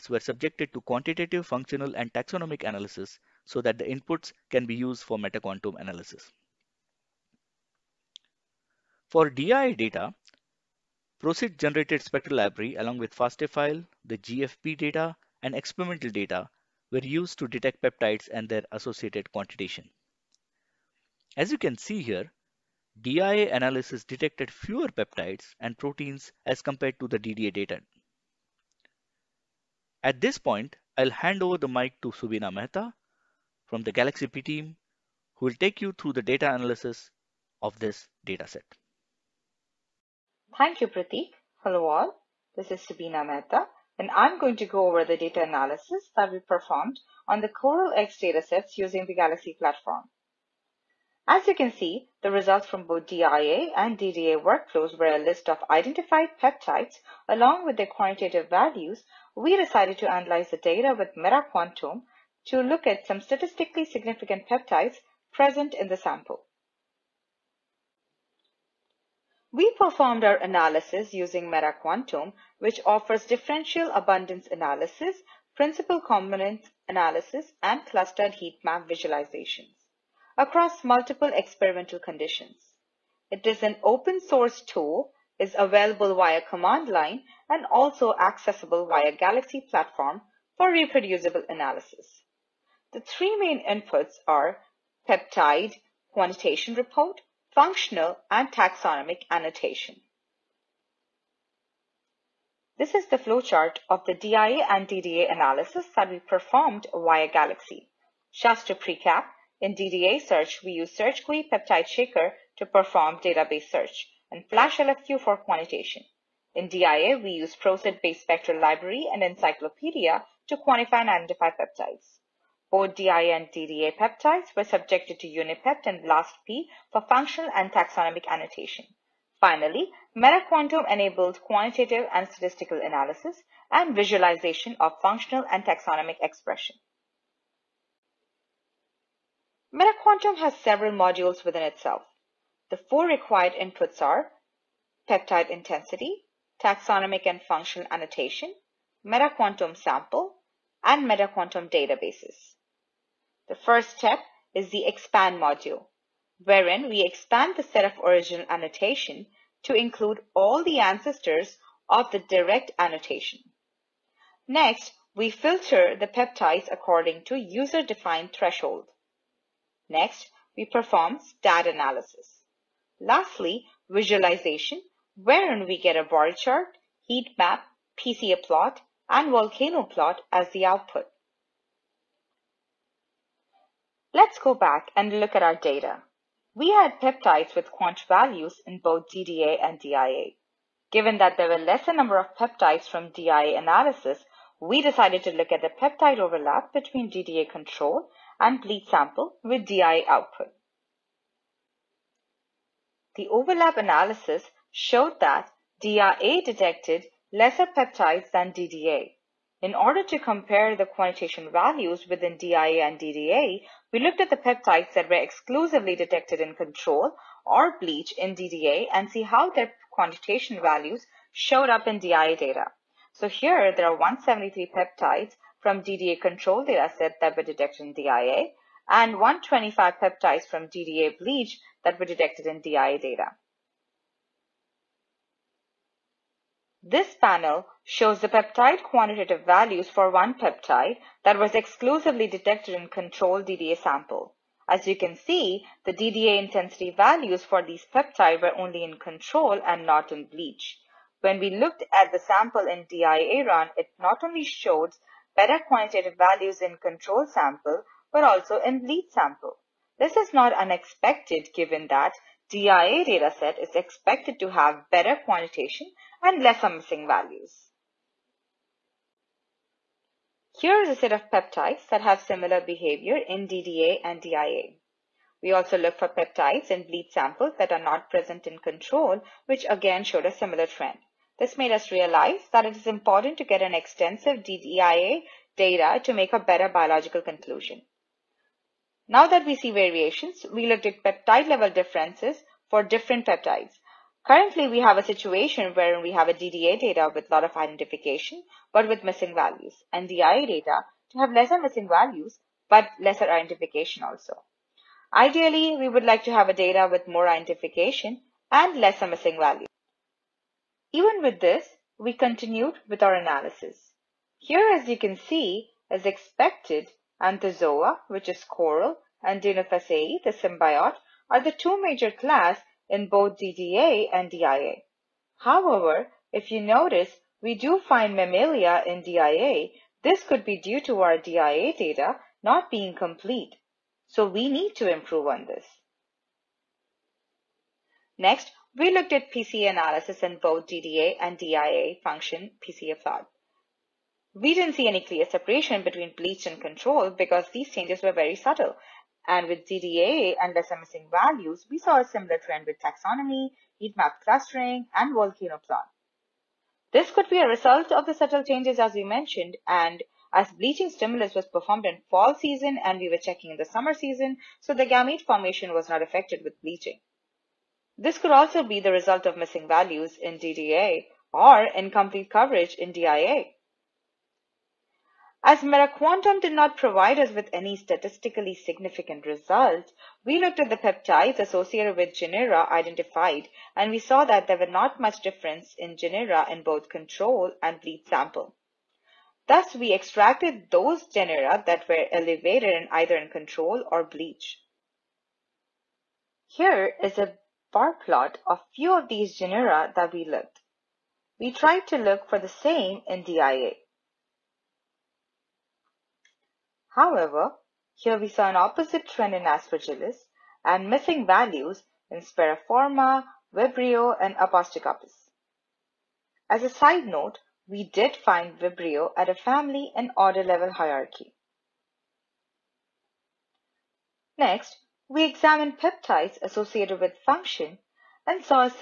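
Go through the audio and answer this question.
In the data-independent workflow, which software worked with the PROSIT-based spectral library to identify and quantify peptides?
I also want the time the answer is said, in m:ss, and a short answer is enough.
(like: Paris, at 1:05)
EncyclopeDIA, at 1:59.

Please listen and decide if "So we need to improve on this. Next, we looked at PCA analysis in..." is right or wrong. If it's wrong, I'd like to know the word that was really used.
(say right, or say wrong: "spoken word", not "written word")
right.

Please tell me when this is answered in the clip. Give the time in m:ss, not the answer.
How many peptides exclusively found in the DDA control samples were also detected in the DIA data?
3:43.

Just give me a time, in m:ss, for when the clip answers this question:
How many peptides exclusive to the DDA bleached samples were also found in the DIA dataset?
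3:49.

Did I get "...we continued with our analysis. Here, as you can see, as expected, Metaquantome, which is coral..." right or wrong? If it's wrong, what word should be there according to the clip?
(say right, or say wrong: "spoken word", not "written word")
wrong: "Anthozoa", not "Metaquantome".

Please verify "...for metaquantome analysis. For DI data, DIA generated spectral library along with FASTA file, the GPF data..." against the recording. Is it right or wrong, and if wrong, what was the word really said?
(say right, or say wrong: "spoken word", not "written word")
wrong: "PROSIT", not "DIA".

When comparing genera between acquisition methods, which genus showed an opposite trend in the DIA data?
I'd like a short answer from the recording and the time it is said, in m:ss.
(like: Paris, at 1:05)
Aspergillus, at 6:49.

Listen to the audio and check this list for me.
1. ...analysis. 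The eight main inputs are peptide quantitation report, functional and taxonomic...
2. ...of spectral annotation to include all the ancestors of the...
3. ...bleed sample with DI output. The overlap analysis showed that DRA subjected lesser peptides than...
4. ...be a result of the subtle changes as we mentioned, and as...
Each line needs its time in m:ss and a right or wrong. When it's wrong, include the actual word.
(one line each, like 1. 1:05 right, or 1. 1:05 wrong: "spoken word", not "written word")
1. 1:31 wrong: "three", not "eight"
2. 2:37 wrong: "original", not "spectral"
3. 3:18 wrong: "detected", not "subjected"
4. 5:57 right.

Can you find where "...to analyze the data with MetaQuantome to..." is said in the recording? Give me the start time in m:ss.
0:59.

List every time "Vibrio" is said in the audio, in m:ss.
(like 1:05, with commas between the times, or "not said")
6:53, 6:58.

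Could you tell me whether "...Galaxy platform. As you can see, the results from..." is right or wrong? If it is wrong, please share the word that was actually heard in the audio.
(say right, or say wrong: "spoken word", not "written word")
right.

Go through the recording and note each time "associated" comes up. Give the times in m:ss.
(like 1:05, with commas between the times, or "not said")
0:18, 6:21, 7:06.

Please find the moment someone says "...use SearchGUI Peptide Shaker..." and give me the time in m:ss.
1:50.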